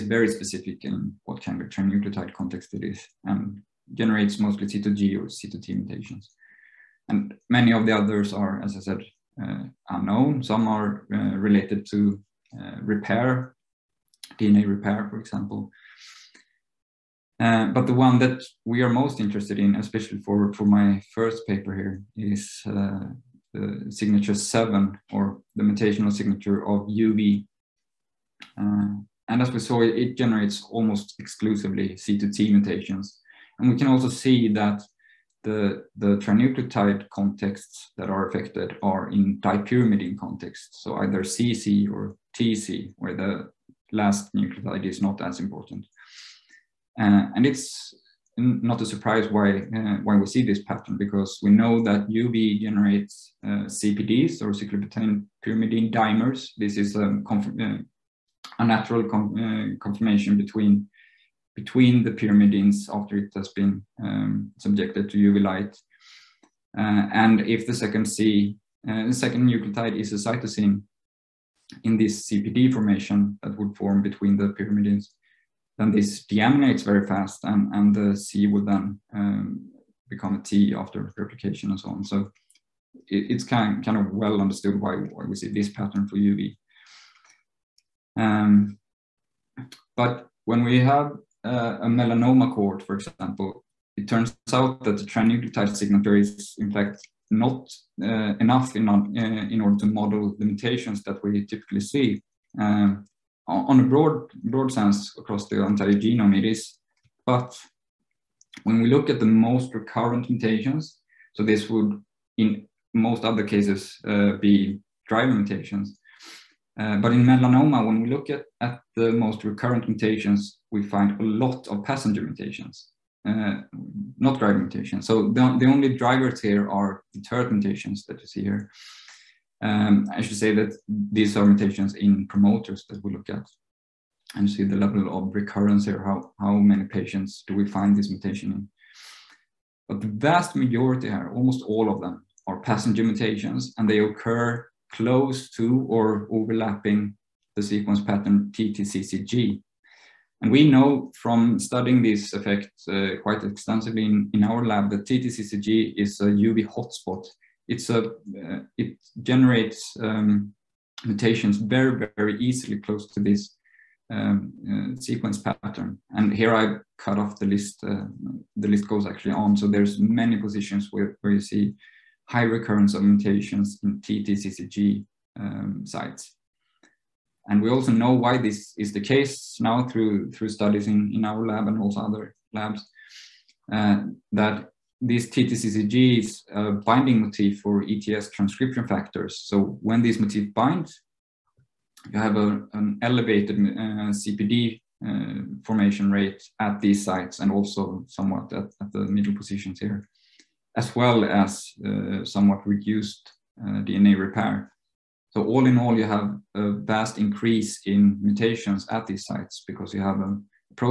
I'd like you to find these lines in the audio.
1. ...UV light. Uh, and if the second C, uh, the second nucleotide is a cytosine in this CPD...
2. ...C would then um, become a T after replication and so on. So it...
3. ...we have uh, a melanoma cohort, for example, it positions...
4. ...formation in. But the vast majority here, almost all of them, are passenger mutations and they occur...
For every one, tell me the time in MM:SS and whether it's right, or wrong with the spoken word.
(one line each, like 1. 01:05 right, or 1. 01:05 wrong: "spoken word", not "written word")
1. 01:05 right
2. 01:18 right
3. 01:30 wrong: "turns", not "positions"
4. 02:18 wrong: "mutation", not "formation".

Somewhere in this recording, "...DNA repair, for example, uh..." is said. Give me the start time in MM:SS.
00:14.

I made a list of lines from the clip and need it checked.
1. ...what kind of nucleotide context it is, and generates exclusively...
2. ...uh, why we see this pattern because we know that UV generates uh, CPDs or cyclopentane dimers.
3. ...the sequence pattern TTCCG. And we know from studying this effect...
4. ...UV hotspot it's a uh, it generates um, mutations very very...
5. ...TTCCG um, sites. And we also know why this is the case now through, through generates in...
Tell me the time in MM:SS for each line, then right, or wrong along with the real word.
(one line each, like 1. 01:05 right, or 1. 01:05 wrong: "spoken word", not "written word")
1. 00:01 wrong: "mostly", not "exclusively"
2. 00:49 right
3. 02:27 right
4. 02:36 right
5. 02:54 wrong: "studies", not "generates".